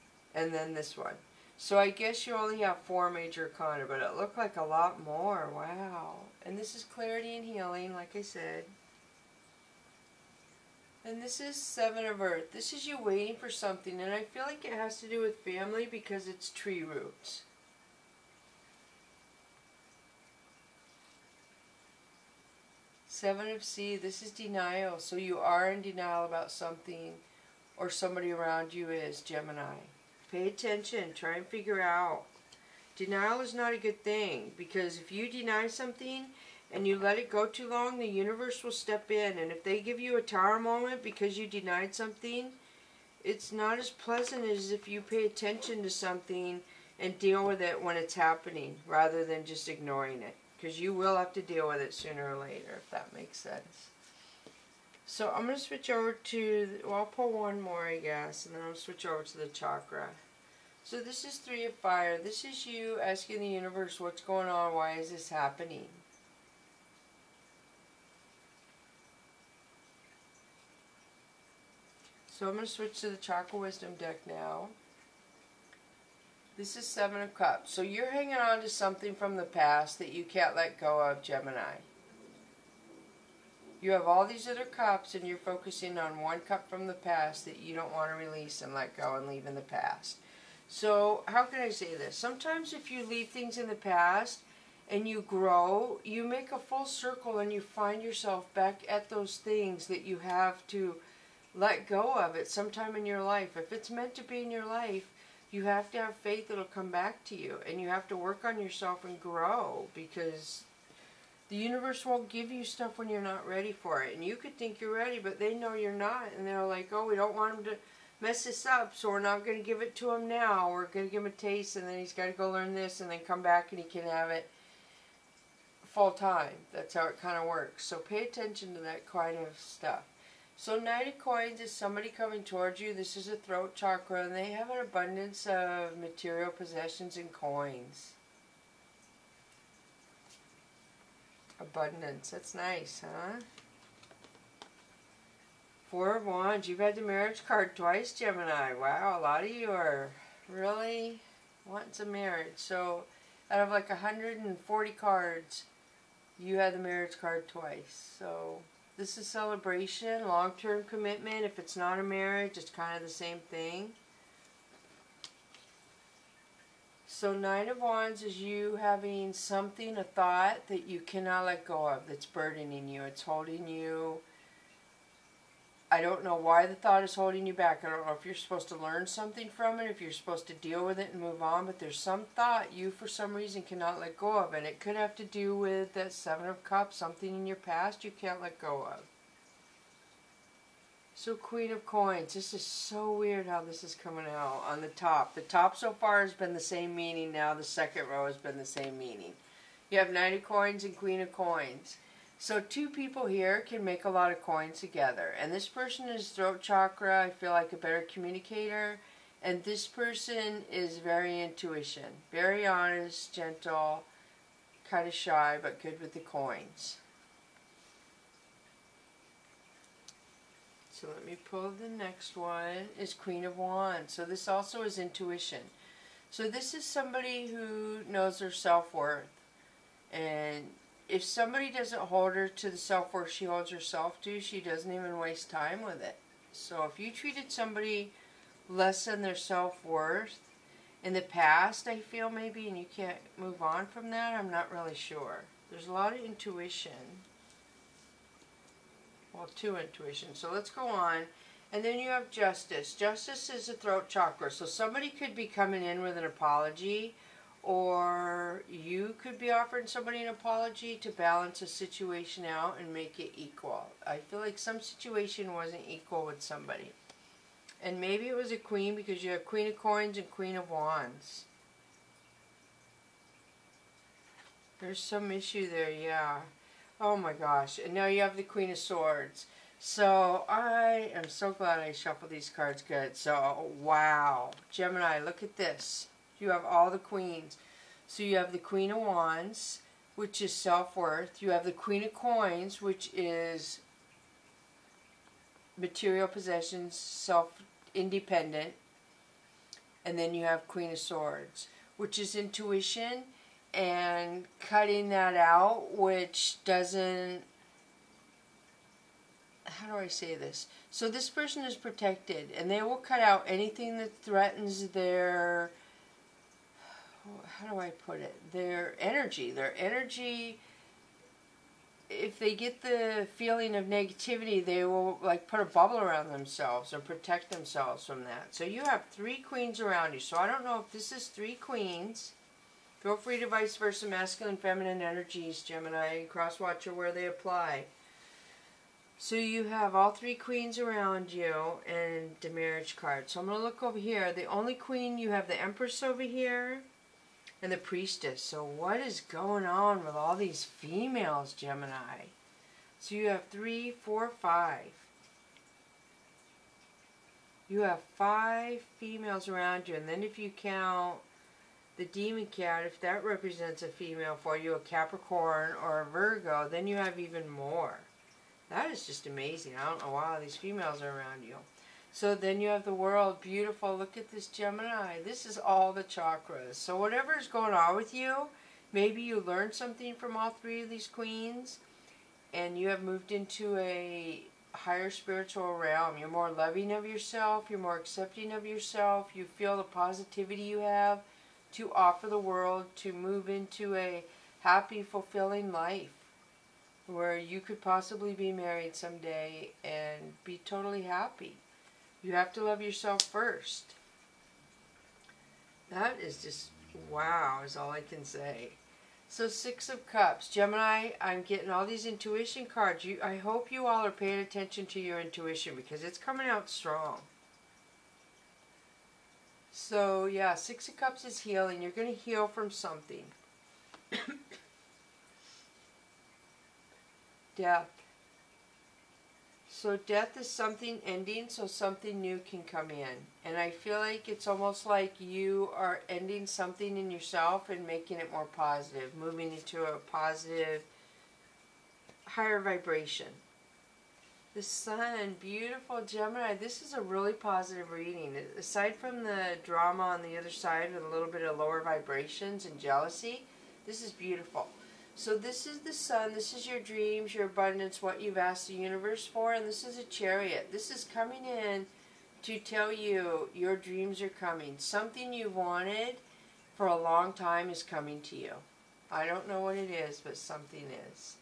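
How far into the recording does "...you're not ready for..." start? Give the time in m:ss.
1:53.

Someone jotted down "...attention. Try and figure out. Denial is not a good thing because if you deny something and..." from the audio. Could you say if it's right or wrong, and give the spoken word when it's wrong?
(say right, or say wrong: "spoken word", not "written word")
right.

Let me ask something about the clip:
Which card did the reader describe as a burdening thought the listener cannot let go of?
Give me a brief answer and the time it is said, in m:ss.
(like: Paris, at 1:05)
Nine of Wands, at 2:47.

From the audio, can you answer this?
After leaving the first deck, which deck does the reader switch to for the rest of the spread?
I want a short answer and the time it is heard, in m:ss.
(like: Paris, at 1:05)
Chakra Wisdom, at 1:13.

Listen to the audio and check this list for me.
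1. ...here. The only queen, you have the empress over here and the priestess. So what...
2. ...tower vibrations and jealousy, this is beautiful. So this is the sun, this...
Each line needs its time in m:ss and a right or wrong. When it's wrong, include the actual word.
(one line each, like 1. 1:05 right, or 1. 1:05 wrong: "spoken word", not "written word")
1. 5:43 right
2. 7:31 wrong: "lower", not "tower".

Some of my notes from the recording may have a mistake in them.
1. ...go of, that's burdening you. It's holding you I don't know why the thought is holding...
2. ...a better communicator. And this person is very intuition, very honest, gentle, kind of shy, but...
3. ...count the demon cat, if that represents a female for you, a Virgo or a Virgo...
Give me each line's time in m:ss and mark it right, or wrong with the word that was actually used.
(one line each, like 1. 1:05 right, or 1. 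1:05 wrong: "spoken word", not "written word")
1. 2:51 right
2. 3:27 right
3. 6:00 wrong: "Capricorn", not "Virgo".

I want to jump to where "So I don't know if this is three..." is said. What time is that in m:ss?
5:30.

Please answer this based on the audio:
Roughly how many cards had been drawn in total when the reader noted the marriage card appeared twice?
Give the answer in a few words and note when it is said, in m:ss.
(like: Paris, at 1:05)
140, at 2:33.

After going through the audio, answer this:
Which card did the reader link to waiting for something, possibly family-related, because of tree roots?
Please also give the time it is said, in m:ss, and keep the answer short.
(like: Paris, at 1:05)
Seven of Earth, at 0:11.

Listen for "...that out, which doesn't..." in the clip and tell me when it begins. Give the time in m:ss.
5:05.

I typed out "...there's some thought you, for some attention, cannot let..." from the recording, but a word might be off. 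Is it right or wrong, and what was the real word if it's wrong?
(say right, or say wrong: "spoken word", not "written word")
wrong: "reason", not "attention".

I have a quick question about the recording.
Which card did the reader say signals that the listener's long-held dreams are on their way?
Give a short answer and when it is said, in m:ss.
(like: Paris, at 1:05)
Chariot, at 7:40.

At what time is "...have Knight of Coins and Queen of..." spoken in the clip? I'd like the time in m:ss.
3:20.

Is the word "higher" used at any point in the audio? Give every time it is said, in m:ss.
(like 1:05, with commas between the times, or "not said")
6:24, 7:22.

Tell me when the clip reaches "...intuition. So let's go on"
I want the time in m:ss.
4:09.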